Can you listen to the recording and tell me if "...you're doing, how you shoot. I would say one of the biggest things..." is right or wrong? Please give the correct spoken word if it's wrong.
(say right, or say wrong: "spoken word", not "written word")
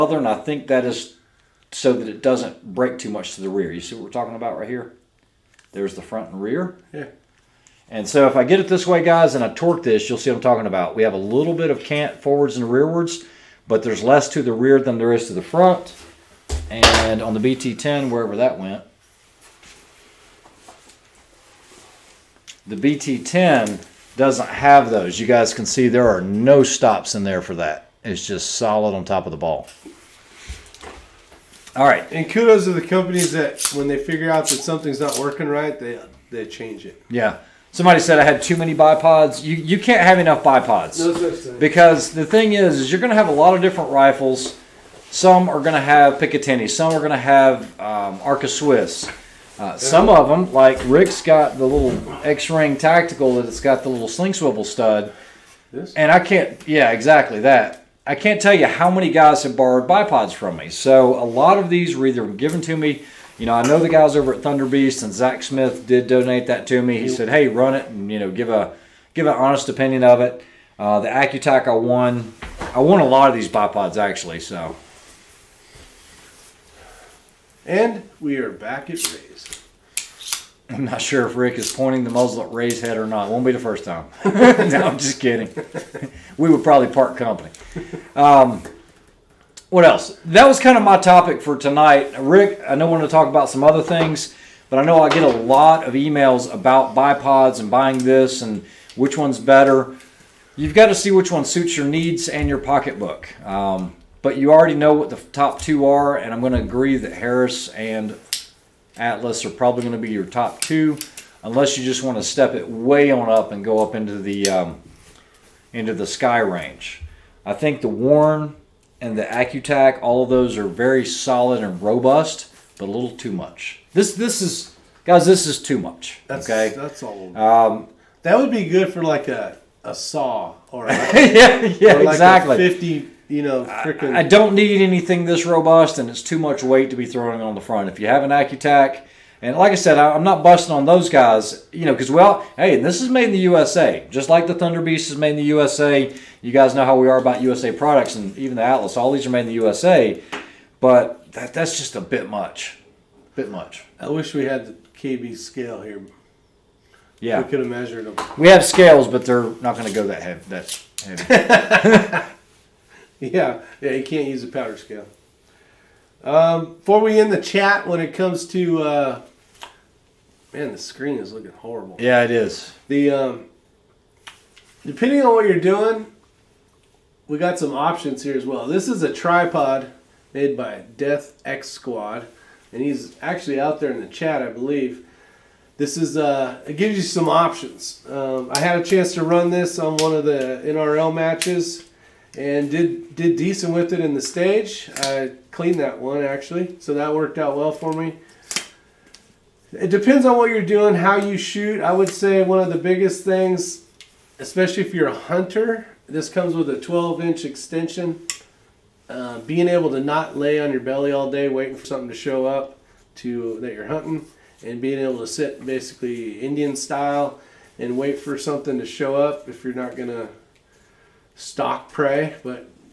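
right.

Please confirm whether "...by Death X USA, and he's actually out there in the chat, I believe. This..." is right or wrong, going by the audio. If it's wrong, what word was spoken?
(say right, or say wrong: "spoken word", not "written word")
wrong: "Squad", not "USA".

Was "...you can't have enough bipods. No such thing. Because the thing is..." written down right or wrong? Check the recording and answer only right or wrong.
right.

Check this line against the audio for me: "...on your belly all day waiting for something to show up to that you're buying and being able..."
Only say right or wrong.
wrong.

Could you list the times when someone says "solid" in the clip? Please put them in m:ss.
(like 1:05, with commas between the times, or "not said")
0:28, 2:01.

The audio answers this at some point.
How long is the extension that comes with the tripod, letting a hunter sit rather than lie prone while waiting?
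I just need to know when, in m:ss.
3:26.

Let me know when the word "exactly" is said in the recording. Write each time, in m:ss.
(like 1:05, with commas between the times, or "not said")
0:56, 2:12.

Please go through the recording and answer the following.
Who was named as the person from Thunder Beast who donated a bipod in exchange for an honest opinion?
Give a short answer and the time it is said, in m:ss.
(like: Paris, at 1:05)
Zach Smith, at 1:05.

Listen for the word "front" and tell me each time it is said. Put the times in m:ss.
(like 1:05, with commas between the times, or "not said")
0:06, 0:15, 2:17.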